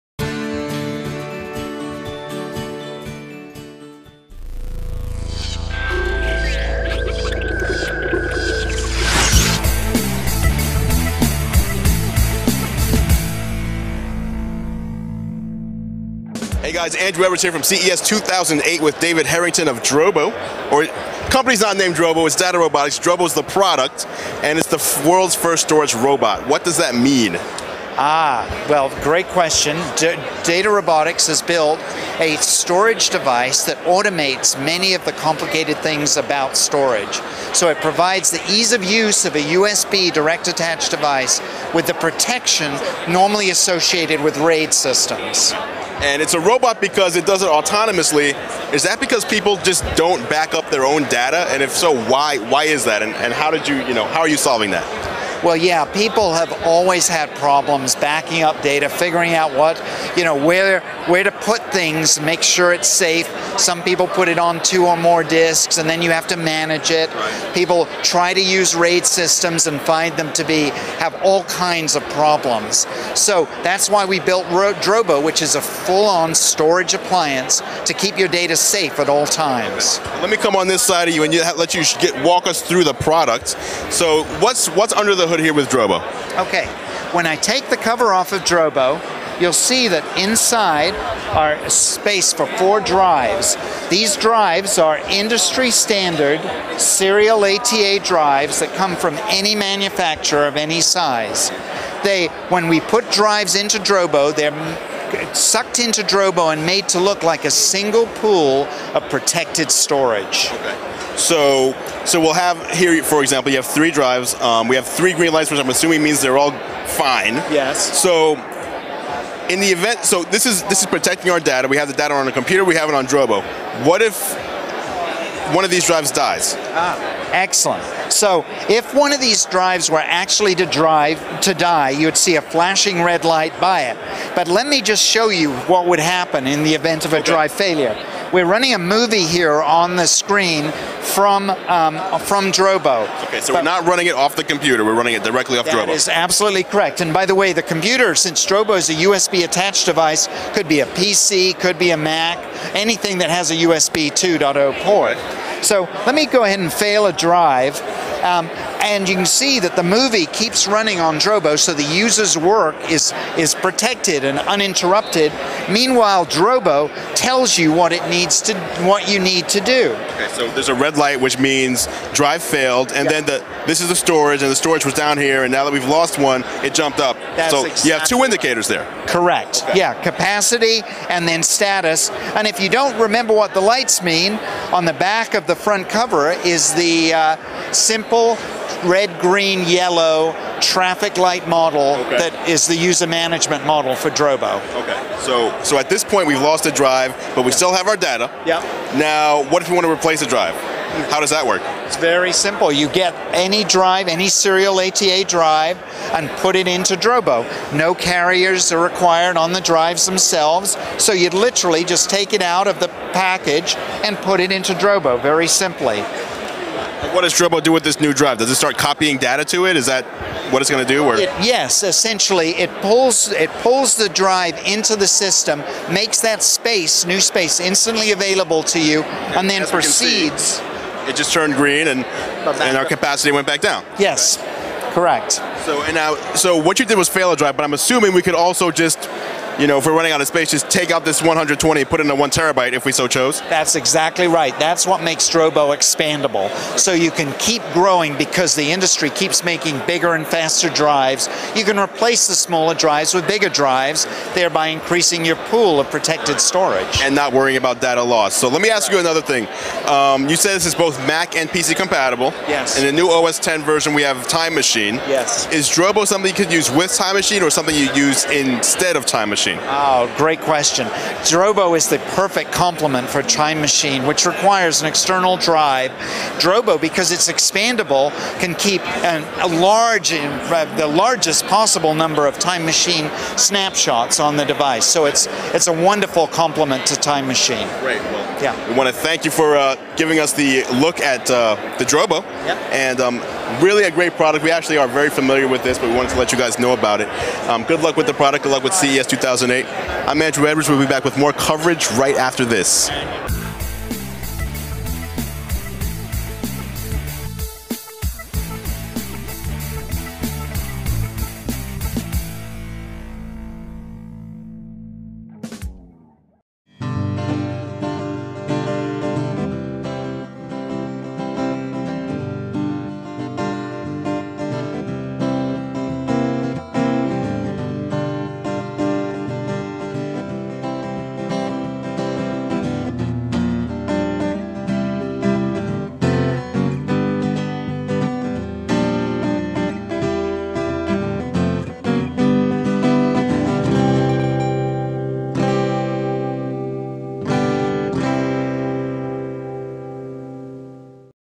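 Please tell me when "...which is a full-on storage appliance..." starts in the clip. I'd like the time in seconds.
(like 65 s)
75 s.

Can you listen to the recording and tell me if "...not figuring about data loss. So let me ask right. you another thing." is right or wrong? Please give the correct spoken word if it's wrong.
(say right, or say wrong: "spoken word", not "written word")
wrong: "worrying", not "figuring".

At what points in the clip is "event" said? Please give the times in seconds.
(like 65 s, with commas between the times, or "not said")
119 s, 136 s.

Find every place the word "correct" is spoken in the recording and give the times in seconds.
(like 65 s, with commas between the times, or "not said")
146 s, 179 s, 234 s.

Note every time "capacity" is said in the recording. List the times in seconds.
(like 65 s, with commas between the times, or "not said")
180 s, 232 s.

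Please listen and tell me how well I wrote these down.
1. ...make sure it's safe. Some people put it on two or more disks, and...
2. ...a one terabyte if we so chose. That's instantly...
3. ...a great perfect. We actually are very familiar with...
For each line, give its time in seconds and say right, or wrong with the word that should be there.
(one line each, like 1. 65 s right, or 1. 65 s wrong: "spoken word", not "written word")
1. 62 s right
2. 242 s wrong: "exactly", not "instantly"
3. 293 s wrong: "product", not "perfect".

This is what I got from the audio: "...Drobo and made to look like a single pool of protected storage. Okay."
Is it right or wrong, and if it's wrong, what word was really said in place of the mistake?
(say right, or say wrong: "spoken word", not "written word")
right.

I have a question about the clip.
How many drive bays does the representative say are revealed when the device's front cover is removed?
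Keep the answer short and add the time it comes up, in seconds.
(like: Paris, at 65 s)
4, at 92 s.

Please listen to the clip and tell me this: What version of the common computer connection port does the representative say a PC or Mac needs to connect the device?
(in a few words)
USB 2.0.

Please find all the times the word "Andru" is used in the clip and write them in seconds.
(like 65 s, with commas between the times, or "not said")
16 s, 300 s.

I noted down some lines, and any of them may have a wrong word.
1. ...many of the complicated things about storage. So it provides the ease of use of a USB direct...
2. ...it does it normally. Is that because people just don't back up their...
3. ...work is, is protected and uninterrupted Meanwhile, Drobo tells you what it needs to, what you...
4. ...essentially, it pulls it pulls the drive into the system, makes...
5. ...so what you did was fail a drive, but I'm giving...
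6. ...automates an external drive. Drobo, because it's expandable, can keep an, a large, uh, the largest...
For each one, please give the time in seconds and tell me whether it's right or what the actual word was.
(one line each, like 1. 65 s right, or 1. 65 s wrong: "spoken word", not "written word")
1. 34 s right
2. 47 s wrong: "autonomously", not "normally"
3. 162 s right
4. 221 s right
5. 236 s wrong: "assuming", not "giving"
6. 274 s wrong: "requires", not "automates".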